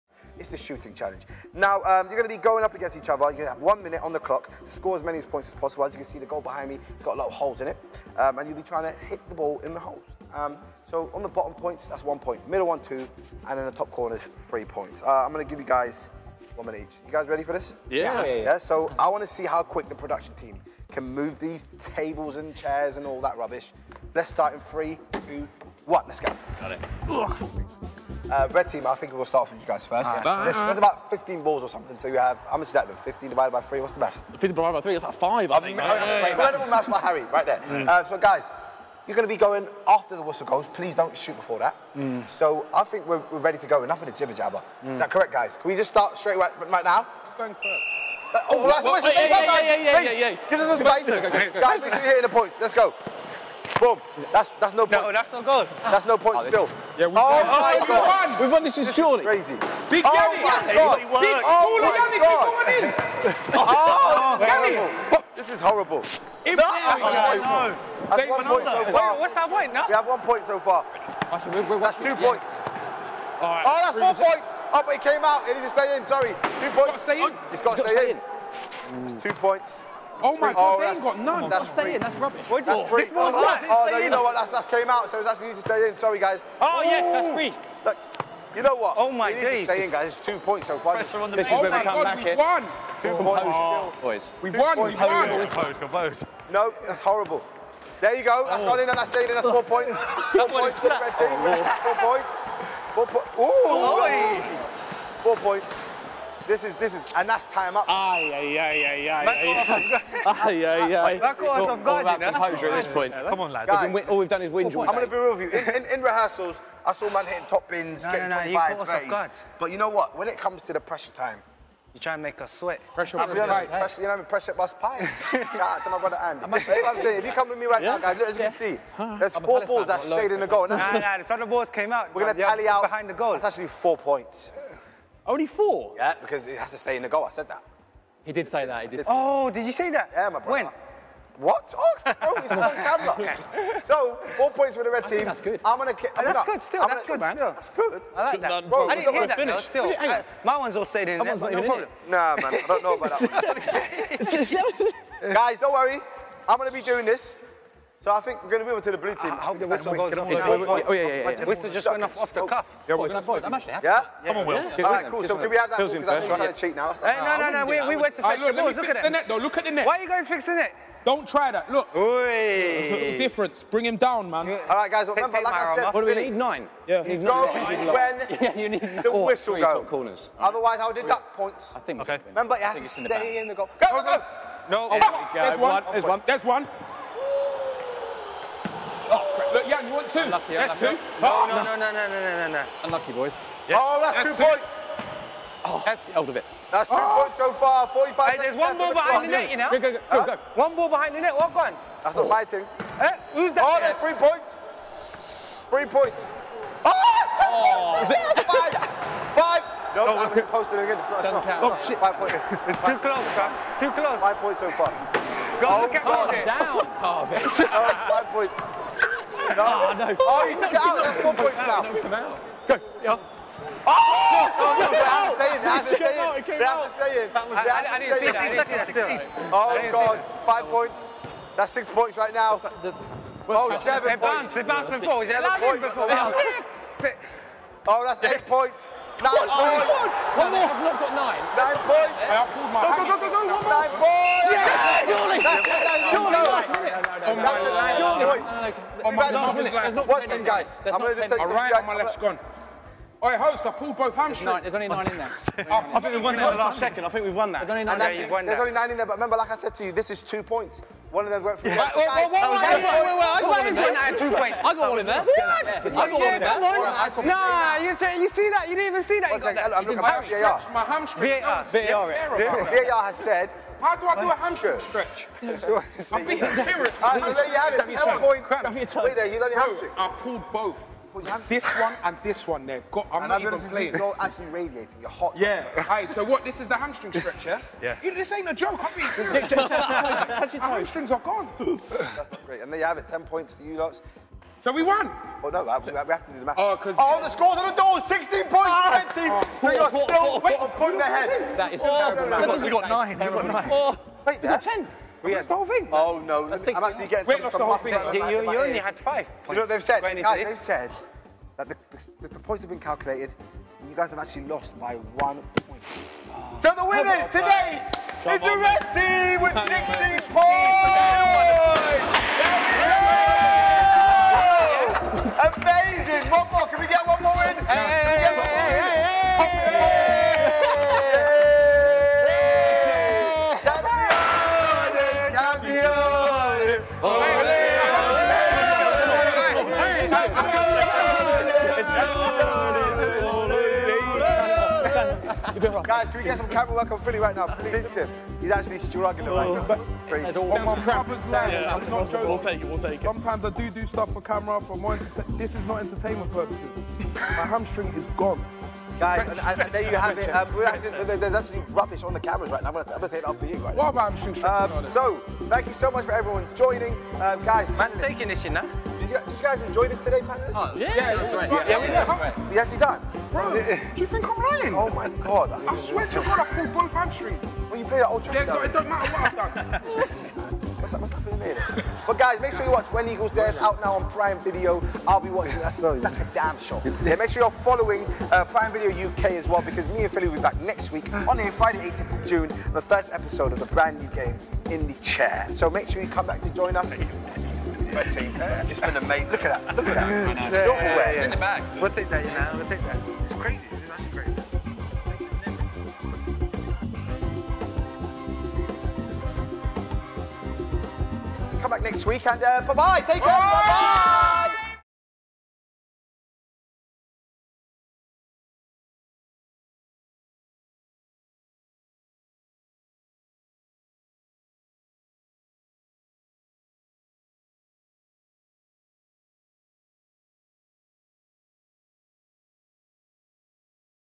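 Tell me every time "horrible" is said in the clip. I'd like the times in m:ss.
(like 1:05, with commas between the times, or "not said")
1:05, 1:36.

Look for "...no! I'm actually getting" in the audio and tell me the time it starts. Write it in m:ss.
5:06.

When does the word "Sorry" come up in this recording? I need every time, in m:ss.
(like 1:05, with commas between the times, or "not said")
1:16, 1:25.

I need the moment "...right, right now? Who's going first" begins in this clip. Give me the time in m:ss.
0:46.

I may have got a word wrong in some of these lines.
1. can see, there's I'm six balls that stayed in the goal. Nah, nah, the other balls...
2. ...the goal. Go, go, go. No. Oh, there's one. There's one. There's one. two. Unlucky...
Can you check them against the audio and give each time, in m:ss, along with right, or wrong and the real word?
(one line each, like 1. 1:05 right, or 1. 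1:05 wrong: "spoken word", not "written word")
1. 2:08 wrong: "four", not "six"
2. 3:03 right.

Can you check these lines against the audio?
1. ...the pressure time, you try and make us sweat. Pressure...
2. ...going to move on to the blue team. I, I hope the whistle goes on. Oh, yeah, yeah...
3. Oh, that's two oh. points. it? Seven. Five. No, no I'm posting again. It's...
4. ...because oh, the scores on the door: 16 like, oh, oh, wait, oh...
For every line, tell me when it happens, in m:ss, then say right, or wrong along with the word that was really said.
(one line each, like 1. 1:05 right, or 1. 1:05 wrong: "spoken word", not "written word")
1. 2:00 right
2. 2:38 right
3. 3:26 wrong: "Five", not "Seven"
4. 4:56 right.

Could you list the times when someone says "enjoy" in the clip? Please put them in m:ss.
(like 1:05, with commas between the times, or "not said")
6:09.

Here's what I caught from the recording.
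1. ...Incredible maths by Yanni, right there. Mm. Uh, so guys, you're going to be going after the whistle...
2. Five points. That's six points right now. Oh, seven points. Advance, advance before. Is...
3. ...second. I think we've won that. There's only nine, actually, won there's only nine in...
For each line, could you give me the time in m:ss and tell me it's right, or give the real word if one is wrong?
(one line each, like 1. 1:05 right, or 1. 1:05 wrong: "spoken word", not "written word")
1. 0:36 wrong: "Harry", not "Yanni"
2. 3:50 right
3. 4:16 right.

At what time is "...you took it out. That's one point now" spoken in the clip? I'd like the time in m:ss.
3:40.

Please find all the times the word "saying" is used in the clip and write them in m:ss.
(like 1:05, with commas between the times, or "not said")
1:21, 2:07.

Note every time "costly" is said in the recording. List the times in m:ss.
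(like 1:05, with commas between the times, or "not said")
not said.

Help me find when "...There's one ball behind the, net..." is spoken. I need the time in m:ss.
3:18.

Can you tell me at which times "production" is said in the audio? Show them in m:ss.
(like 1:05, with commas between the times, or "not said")
0:19.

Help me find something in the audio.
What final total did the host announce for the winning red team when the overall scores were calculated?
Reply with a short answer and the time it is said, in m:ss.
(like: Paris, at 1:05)
16, at 5:19.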